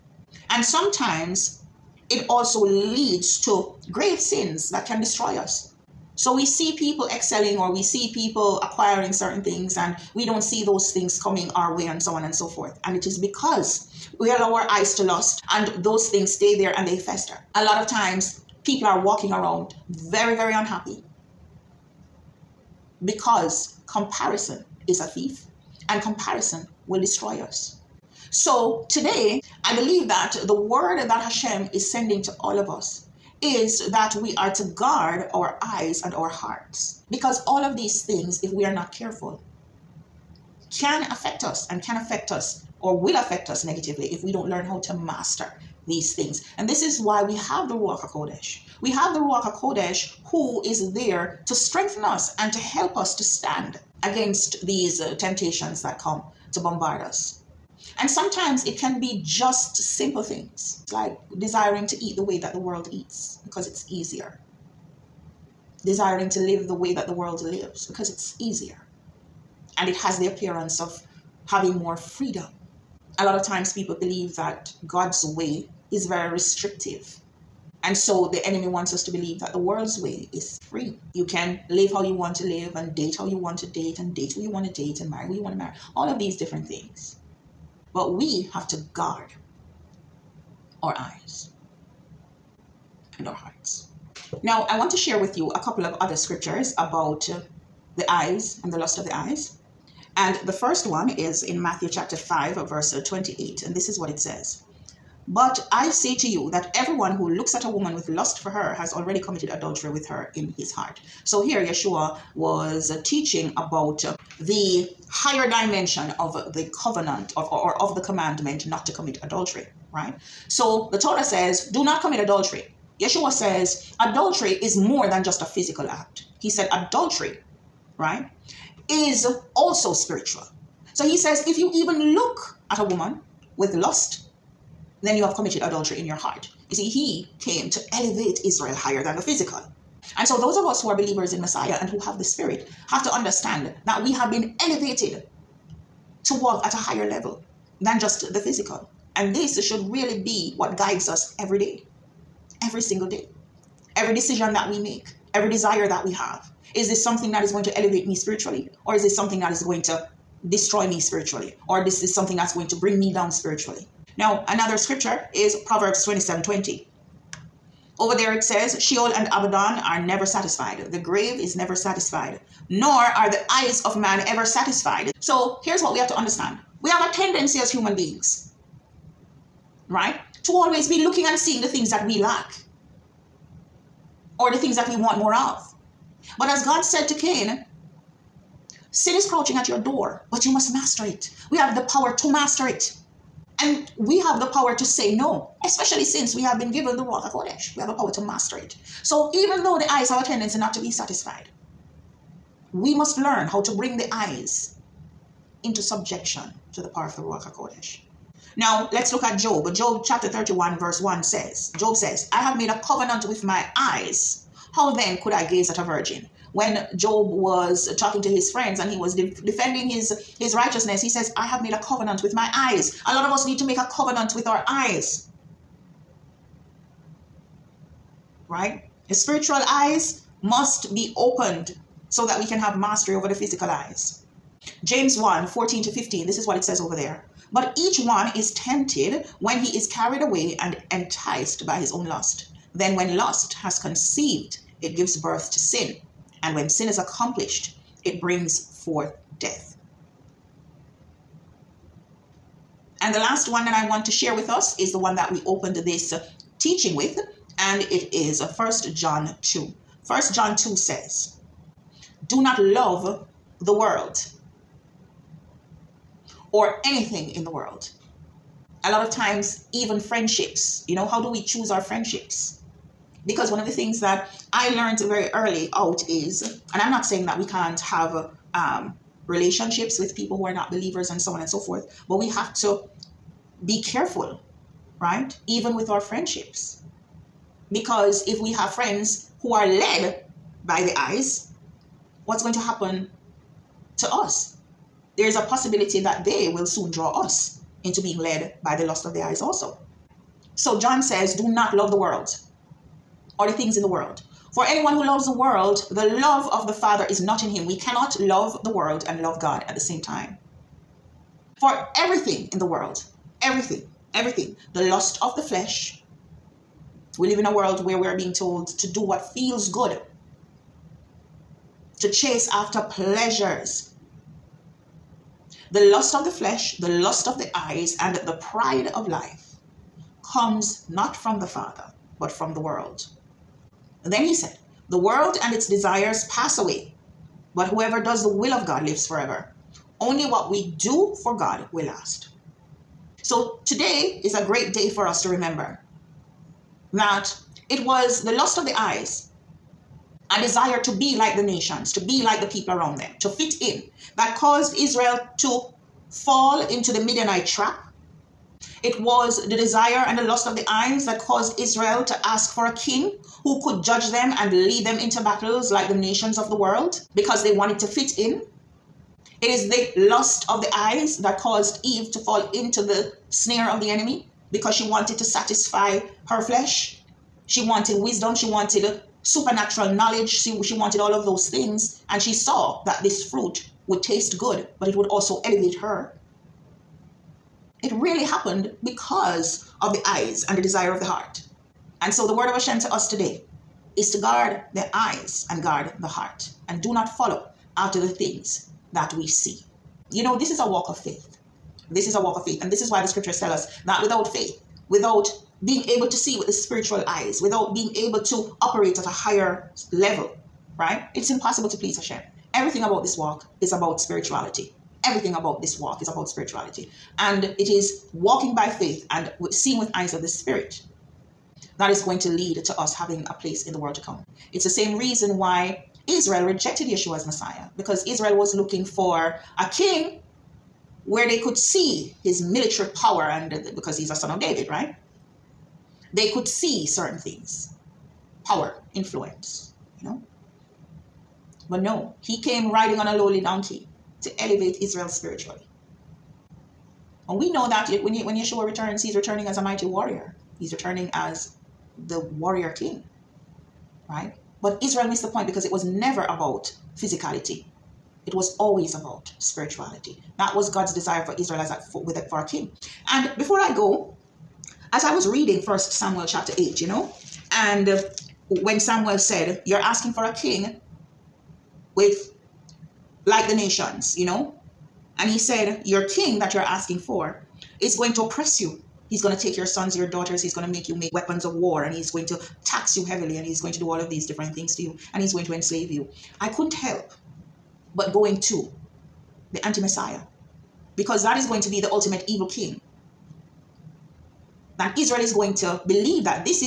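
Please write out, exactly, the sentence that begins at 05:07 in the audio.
We cannot love the world and love God at the same time.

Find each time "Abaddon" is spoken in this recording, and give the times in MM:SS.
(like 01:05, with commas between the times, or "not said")
02:49.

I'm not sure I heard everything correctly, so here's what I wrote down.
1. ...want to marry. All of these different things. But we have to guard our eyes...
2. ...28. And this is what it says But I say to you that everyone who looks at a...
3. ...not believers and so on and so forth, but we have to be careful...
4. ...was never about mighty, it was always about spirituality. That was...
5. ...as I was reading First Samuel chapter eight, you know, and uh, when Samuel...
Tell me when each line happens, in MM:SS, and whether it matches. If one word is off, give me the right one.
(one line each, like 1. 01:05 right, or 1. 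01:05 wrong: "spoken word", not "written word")
1. 01:25 right
2. 01:43 right
3. 04:40 right
4. 07:35 wrong: "physicality", not "mighty"
5. 07:44 right.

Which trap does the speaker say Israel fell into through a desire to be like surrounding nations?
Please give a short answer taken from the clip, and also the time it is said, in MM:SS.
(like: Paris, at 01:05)
the Midianite trap, at 05:57.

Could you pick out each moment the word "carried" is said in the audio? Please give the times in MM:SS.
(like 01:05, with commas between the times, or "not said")
03:59.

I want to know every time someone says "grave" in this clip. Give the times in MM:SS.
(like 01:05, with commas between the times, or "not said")
00:03, 02:50.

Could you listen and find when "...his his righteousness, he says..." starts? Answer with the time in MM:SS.
03:39.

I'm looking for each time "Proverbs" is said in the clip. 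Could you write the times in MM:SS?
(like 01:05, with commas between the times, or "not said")
02:45.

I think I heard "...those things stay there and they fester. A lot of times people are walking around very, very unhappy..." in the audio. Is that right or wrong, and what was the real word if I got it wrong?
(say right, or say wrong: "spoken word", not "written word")
right.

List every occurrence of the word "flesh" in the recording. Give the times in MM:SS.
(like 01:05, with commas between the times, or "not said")
05:15, 05:26, 06:16.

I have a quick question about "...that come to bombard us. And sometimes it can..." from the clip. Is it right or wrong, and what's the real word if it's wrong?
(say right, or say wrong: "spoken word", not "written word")
right.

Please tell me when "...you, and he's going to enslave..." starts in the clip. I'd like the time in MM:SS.
08:04.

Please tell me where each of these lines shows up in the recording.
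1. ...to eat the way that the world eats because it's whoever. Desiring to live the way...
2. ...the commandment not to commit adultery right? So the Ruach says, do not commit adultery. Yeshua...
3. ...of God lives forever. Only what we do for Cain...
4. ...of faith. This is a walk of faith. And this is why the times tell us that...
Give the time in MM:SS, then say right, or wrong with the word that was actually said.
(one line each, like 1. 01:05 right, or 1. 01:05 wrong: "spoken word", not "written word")
1. 01:01 wrong: "easier", not "whoever"
2. 01:57 wrong: "Torah", not "Ruach"
3. 05:38 wrong: "God", not "Cain"
4. 06:40 wrong: "scriptures", not "times".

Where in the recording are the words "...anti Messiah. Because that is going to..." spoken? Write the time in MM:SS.
08:09.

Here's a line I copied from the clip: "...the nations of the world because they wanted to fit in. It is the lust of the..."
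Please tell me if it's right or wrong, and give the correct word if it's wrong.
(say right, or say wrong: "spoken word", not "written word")
right.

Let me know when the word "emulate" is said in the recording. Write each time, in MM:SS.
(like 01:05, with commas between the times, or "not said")
not said.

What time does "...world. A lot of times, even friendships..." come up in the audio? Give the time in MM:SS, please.
04:27.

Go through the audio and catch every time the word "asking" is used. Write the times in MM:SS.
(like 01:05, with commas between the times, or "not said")
07:49, 07:56.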